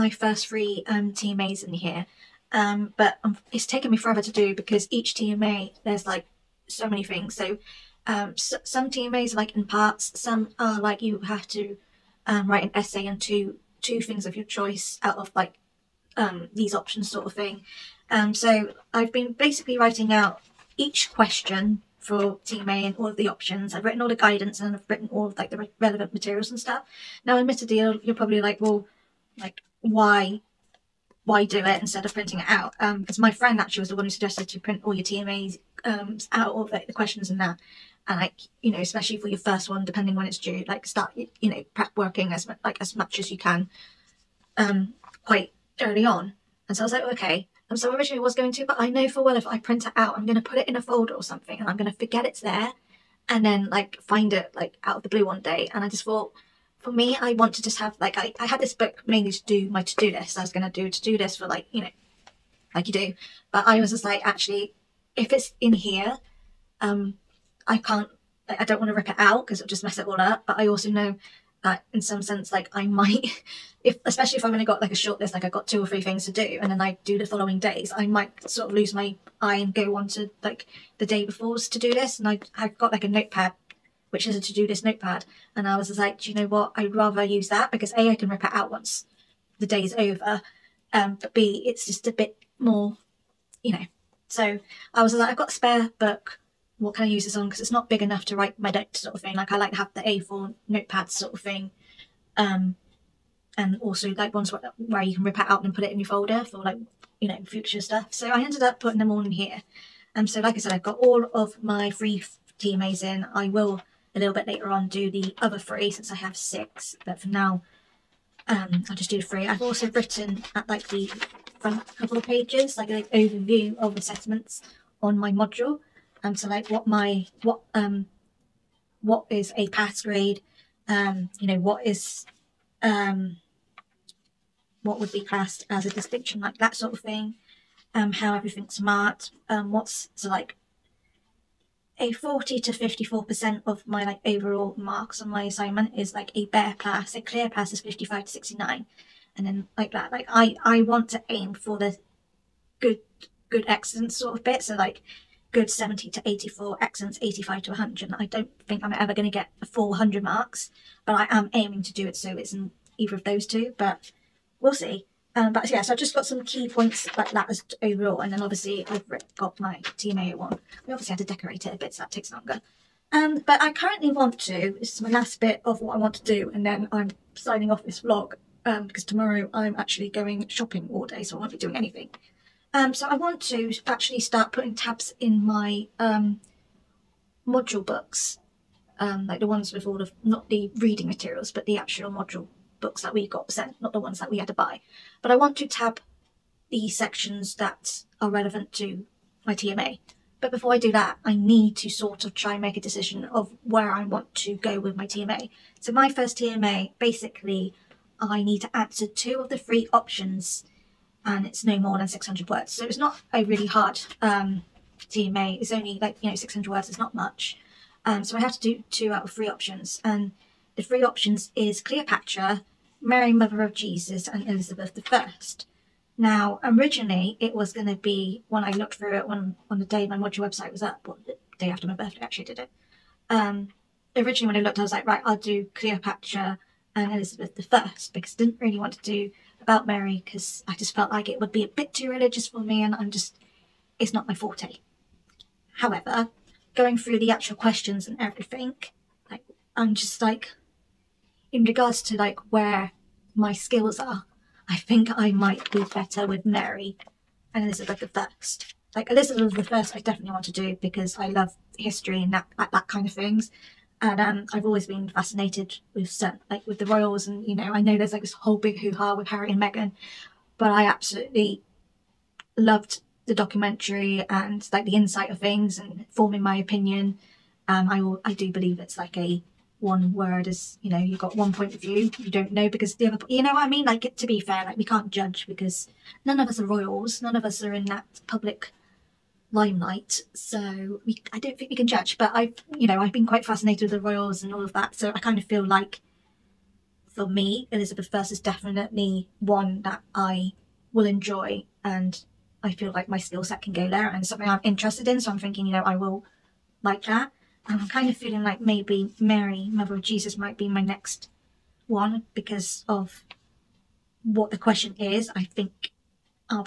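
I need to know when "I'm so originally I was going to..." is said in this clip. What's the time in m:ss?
0:47.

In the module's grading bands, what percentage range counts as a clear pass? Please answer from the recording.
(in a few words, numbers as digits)
55 to 69.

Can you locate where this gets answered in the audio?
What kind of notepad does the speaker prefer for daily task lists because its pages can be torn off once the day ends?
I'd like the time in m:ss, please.
1:24.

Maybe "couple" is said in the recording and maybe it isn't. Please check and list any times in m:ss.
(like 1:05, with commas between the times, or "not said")
2:01.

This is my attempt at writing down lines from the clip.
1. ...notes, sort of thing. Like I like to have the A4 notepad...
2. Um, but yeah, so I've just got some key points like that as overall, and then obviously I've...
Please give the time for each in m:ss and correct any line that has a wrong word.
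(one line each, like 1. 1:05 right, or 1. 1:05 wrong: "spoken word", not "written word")
1. 1:38 right
2. 2:45 right.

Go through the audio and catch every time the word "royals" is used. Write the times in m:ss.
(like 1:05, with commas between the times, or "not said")
4:26, 4:46, 4:54.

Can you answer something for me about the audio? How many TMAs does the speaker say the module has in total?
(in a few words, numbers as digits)
6.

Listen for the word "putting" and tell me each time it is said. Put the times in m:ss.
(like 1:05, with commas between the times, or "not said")
1:48, 3:04.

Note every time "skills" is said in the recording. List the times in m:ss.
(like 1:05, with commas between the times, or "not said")
4:13, 5:03.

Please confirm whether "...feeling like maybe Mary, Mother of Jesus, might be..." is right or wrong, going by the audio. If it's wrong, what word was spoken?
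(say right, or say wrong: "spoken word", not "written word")
right.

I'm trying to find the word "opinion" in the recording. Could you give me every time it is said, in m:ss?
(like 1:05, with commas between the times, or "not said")
4:36.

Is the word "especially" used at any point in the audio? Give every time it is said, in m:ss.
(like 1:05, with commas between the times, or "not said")
0:38, 1:14.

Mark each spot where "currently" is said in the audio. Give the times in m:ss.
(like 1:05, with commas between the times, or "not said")
2:53.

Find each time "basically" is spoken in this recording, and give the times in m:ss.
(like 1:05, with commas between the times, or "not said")
0:19, 3:26.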